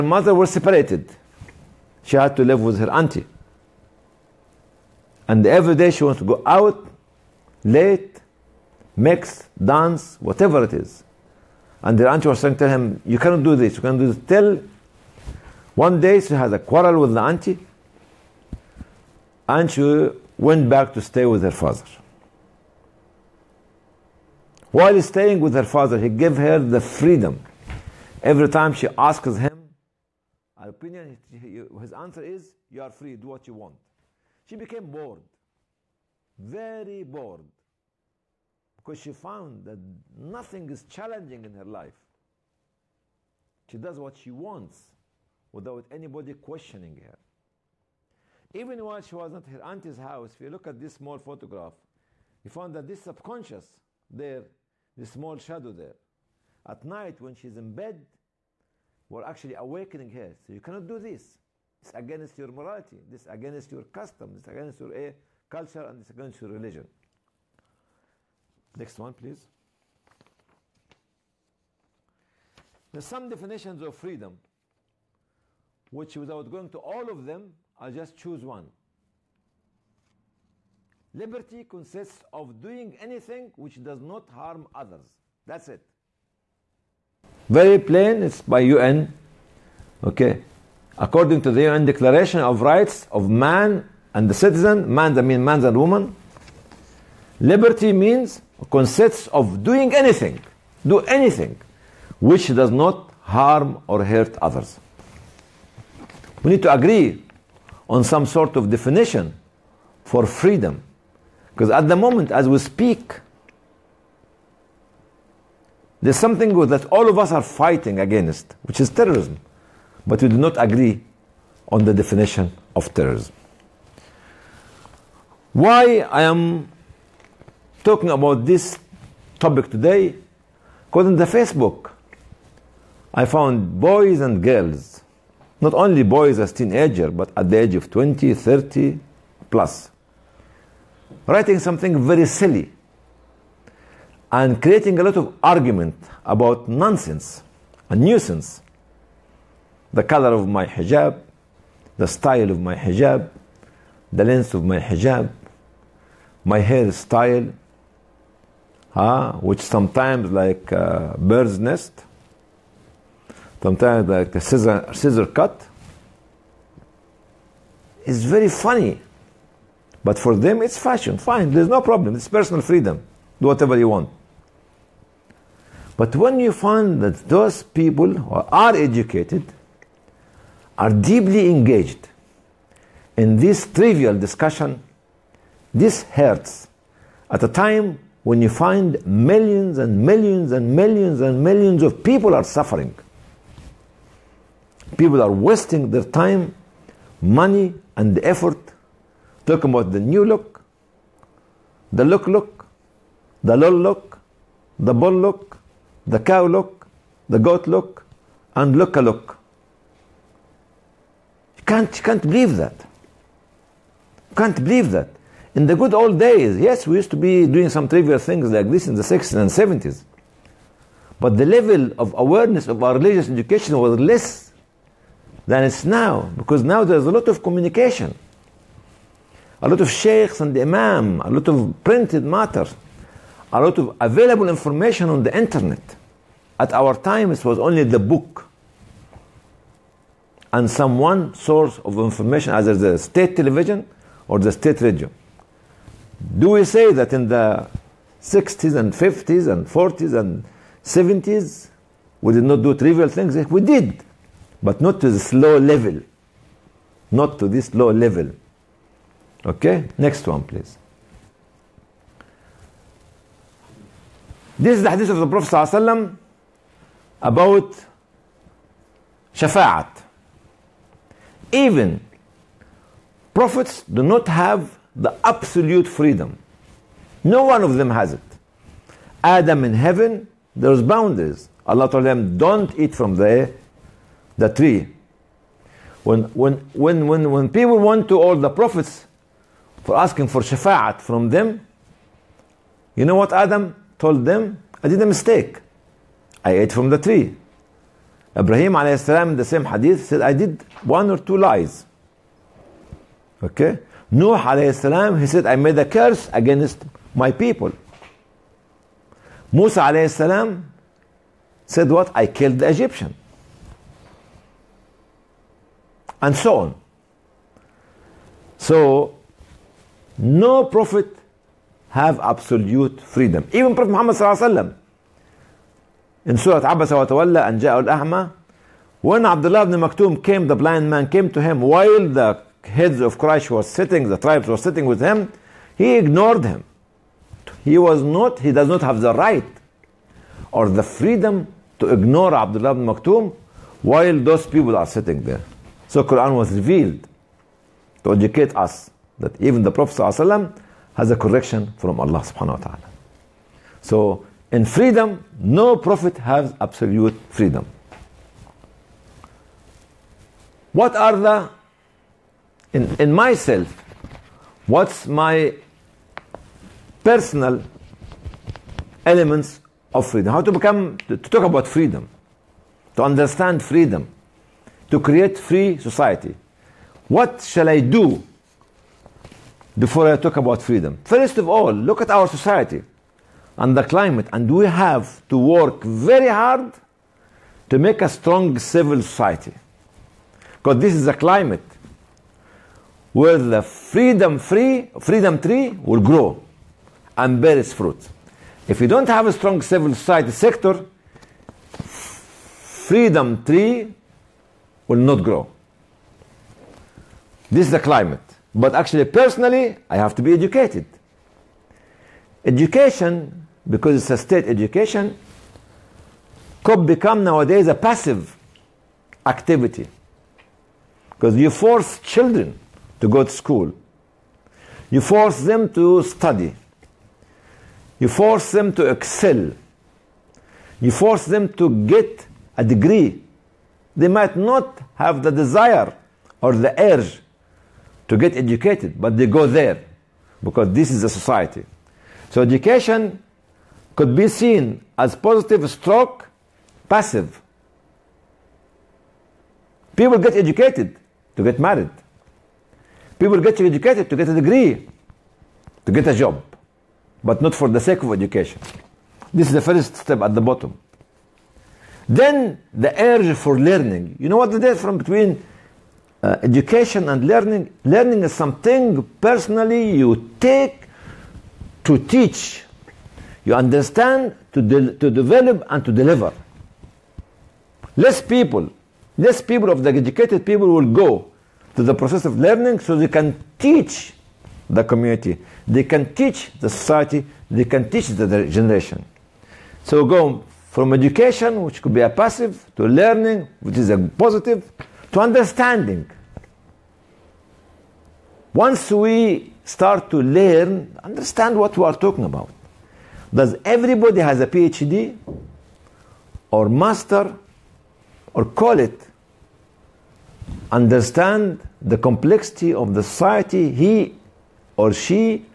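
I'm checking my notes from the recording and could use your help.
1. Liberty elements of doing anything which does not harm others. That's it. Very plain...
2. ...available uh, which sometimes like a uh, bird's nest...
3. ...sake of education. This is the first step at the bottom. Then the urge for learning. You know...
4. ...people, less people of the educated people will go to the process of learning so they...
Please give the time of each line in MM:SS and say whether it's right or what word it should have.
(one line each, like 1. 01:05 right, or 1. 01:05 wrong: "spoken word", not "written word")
1. 01:21 wrong: "consists", not "elements"
2. 02:36 wrong: "style", not "available"
3. 07:37 right
4. 07:58 right.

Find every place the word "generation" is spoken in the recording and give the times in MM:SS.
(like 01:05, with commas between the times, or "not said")
08:08.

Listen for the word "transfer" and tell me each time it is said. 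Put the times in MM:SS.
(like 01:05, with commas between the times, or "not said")
not said.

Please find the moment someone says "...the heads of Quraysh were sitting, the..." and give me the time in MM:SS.
05:32.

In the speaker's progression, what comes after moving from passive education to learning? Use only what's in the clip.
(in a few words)
Understanding.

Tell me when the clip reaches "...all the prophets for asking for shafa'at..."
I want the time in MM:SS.
04:48.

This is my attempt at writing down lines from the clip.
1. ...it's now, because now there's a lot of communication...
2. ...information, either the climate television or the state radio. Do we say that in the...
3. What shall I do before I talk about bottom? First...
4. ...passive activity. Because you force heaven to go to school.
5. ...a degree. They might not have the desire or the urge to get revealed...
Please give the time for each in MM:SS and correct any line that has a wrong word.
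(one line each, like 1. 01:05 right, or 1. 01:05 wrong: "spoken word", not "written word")
1. 03:45 right
2. 04:01 wrong: "state", not "climate"
3. 06:17 wrong: "freedom", not "bottom"
4. 06:57 wrong: "children", not "heaven"
5. 07:12 wrong: "educated", not "revealed".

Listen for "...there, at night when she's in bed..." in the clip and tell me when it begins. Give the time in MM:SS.
00:55.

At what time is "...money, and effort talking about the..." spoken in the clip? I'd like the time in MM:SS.
03:17.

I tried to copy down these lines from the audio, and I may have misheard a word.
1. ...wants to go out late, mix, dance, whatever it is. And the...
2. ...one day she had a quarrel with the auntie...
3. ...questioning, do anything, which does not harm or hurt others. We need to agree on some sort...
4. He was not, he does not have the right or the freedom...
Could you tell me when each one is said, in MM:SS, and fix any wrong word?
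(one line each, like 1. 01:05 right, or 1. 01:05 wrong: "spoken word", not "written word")
1. 00:06 right
2. 00:15 right
3. 01:39 wrong: "anything", not "questioning"
4. 05:37 right.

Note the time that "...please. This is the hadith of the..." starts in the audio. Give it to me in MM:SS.
04:20.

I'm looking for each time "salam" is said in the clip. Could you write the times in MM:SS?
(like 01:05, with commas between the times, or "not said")
04:58, 05:04, 05:10.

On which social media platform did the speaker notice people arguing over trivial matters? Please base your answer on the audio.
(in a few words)
Facebook.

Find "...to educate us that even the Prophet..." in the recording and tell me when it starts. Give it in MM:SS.
05:48.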